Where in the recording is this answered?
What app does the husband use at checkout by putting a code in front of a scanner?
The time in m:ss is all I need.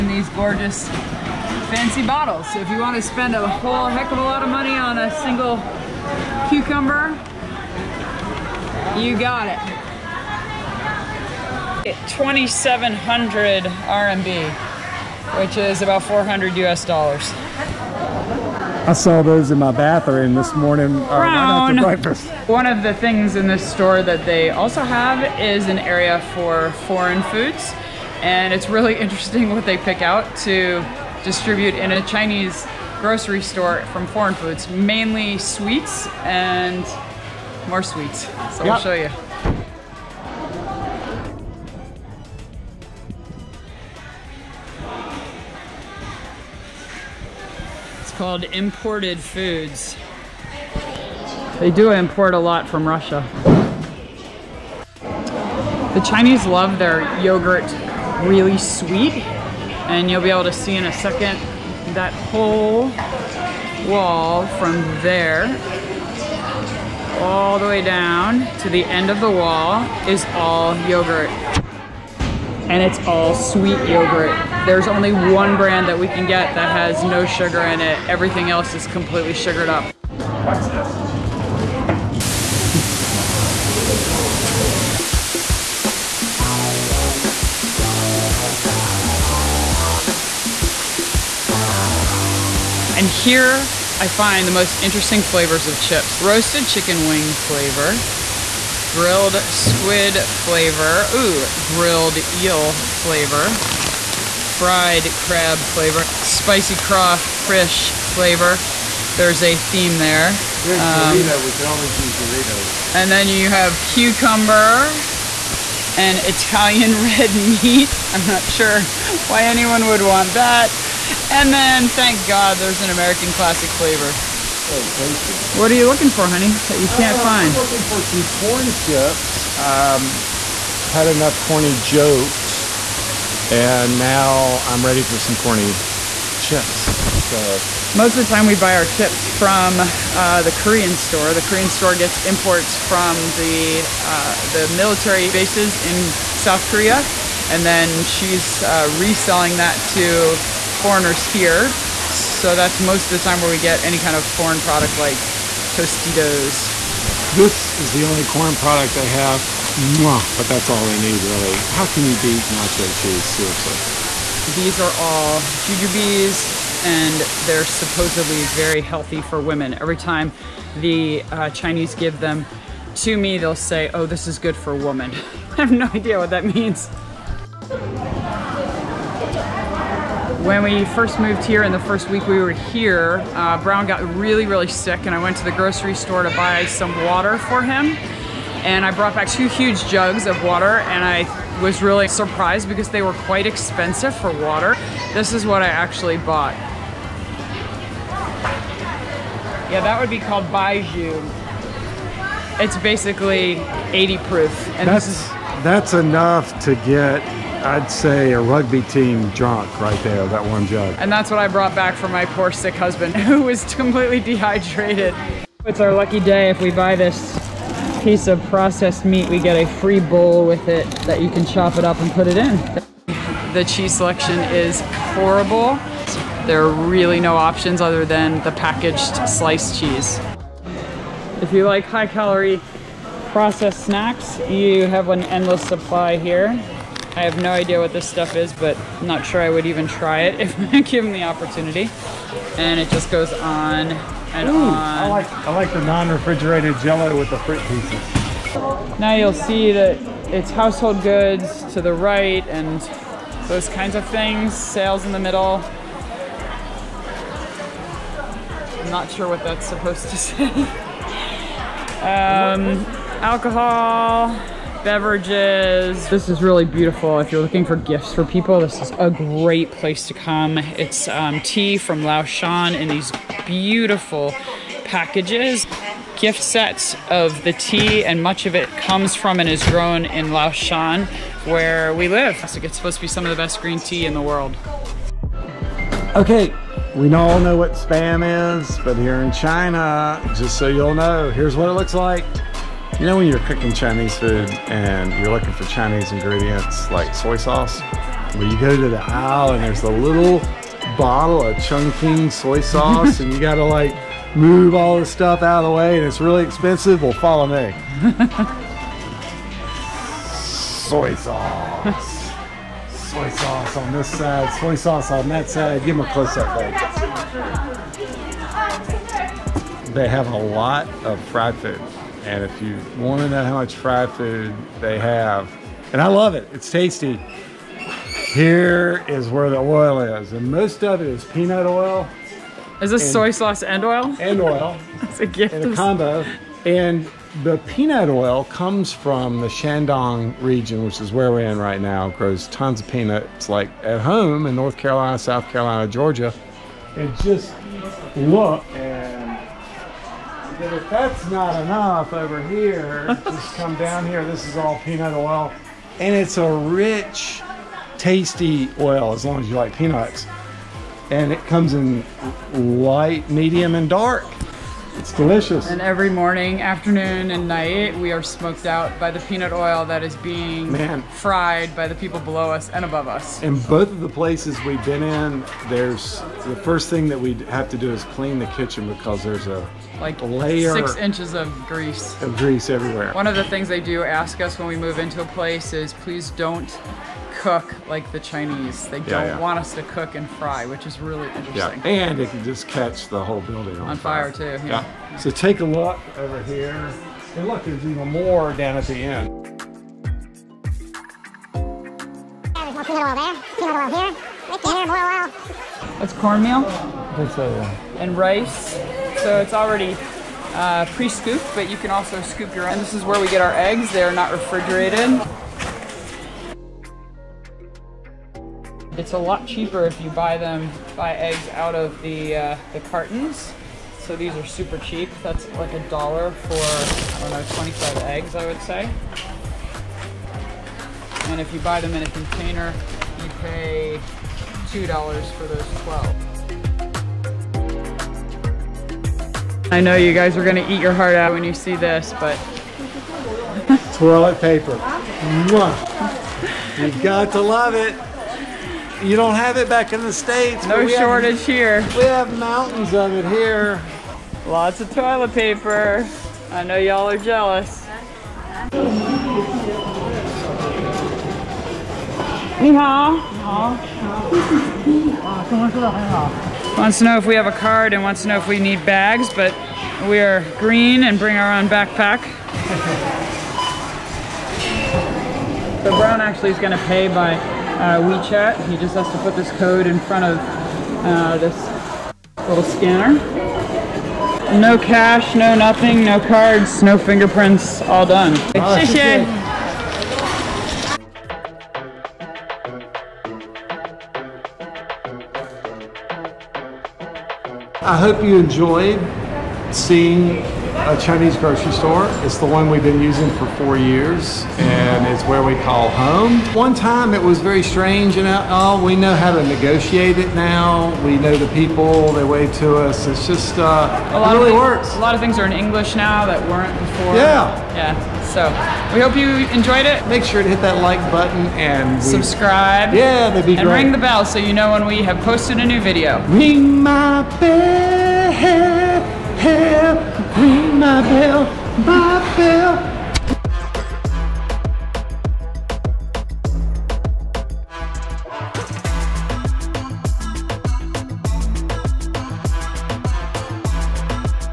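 7:57.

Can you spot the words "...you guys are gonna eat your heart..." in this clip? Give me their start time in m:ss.
7:19.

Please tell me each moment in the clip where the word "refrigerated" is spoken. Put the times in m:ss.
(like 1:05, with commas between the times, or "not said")
4:05, 6:54.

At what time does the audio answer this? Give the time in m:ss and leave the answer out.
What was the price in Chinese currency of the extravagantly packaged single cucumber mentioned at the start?
0:12.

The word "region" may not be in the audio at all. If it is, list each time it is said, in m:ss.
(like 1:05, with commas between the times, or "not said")
5:40.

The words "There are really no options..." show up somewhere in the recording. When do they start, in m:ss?
3:46.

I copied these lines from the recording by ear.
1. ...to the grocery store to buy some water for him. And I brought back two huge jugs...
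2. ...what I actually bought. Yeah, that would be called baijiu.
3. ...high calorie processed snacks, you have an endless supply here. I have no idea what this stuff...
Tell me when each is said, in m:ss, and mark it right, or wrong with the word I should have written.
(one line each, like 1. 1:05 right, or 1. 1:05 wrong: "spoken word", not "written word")
1. 3:05 right
2. 3:15 right
3. 3:51 right.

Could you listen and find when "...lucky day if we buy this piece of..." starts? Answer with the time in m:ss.
3:35.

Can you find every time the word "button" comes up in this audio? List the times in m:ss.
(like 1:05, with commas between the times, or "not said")
8:41.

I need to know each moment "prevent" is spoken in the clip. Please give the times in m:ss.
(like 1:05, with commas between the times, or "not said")
not said.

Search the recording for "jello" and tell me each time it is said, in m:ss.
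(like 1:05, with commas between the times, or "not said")
4:06.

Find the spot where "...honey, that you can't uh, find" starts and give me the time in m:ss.
2:06.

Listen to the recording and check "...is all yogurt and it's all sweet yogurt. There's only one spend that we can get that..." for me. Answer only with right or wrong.
wrong.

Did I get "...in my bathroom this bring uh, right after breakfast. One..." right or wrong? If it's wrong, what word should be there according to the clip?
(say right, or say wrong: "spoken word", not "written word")
wrong: "morning", not "bring".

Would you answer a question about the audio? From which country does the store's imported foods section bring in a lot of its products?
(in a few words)
Russia.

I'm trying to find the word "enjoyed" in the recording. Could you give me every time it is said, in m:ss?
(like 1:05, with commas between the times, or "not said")
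8:18, 8:39.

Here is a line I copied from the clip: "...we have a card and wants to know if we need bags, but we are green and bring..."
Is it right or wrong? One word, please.
right.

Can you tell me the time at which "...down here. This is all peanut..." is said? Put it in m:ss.
5:53.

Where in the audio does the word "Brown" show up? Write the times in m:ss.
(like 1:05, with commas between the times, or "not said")
3:03, 7:55.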